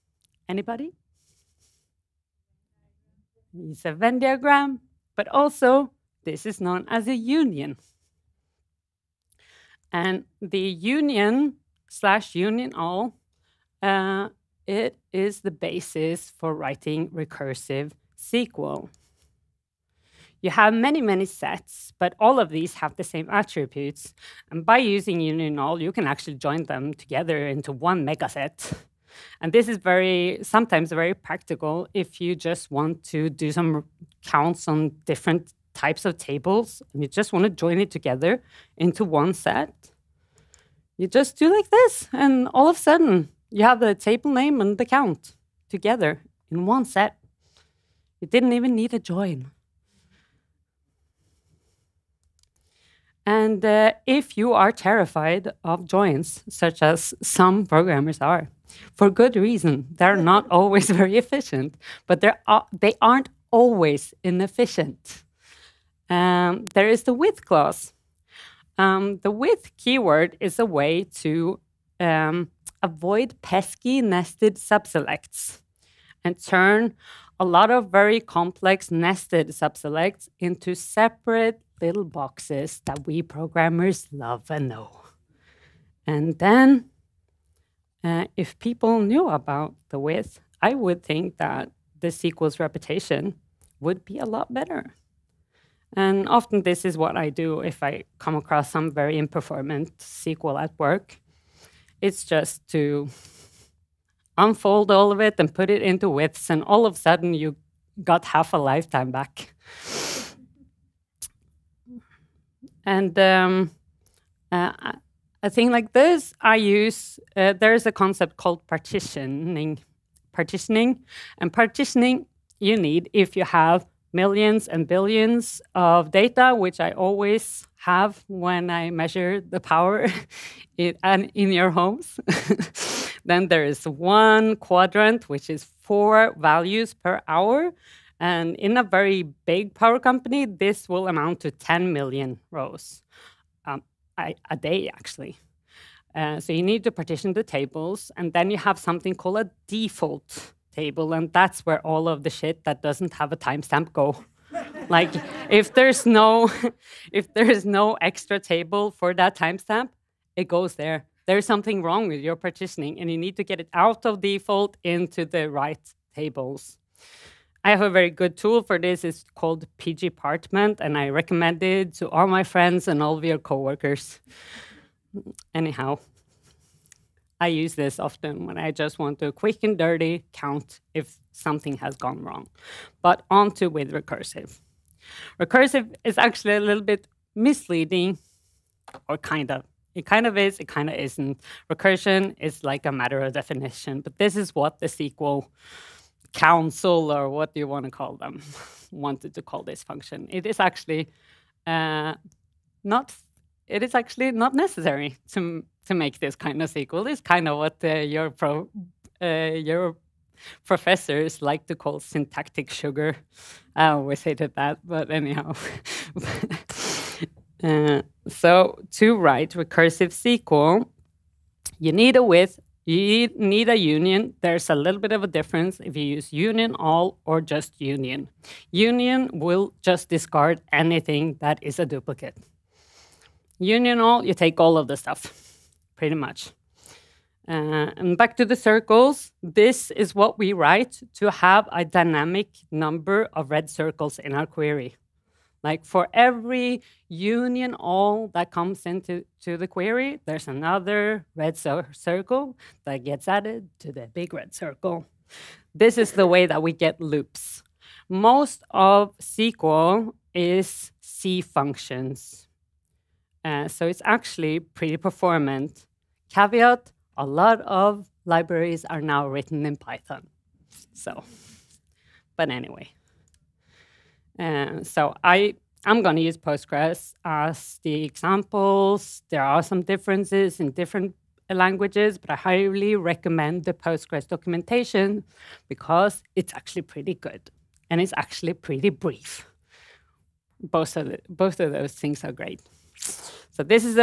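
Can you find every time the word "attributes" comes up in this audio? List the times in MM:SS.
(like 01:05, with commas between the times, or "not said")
00:23.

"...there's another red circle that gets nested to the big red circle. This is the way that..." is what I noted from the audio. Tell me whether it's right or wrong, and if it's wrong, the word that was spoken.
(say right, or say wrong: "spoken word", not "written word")
wrong: "added", not "nested".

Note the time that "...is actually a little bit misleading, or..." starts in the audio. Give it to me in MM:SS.
03:06.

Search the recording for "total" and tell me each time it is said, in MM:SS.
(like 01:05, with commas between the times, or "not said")
not said.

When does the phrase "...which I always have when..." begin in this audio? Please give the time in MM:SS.
02:06.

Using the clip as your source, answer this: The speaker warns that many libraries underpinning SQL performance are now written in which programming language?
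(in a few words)
Python.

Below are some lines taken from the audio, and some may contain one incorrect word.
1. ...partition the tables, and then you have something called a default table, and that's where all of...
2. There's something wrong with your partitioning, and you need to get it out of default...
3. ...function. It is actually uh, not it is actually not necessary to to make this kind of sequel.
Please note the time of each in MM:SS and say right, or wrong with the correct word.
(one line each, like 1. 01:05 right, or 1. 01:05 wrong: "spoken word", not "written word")
1. 02:26 right
2. 02:41 right
3. 03:19 right.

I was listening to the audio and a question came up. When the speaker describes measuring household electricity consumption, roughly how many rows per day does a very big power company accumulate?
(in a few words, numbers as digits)
10 million.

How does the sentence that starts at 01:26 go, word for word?
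And then, uh, if people knew about the with, I would think that the SQL's reputation would be a lot better.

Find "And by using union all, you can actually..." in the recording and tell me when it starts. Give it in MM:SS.
00:24.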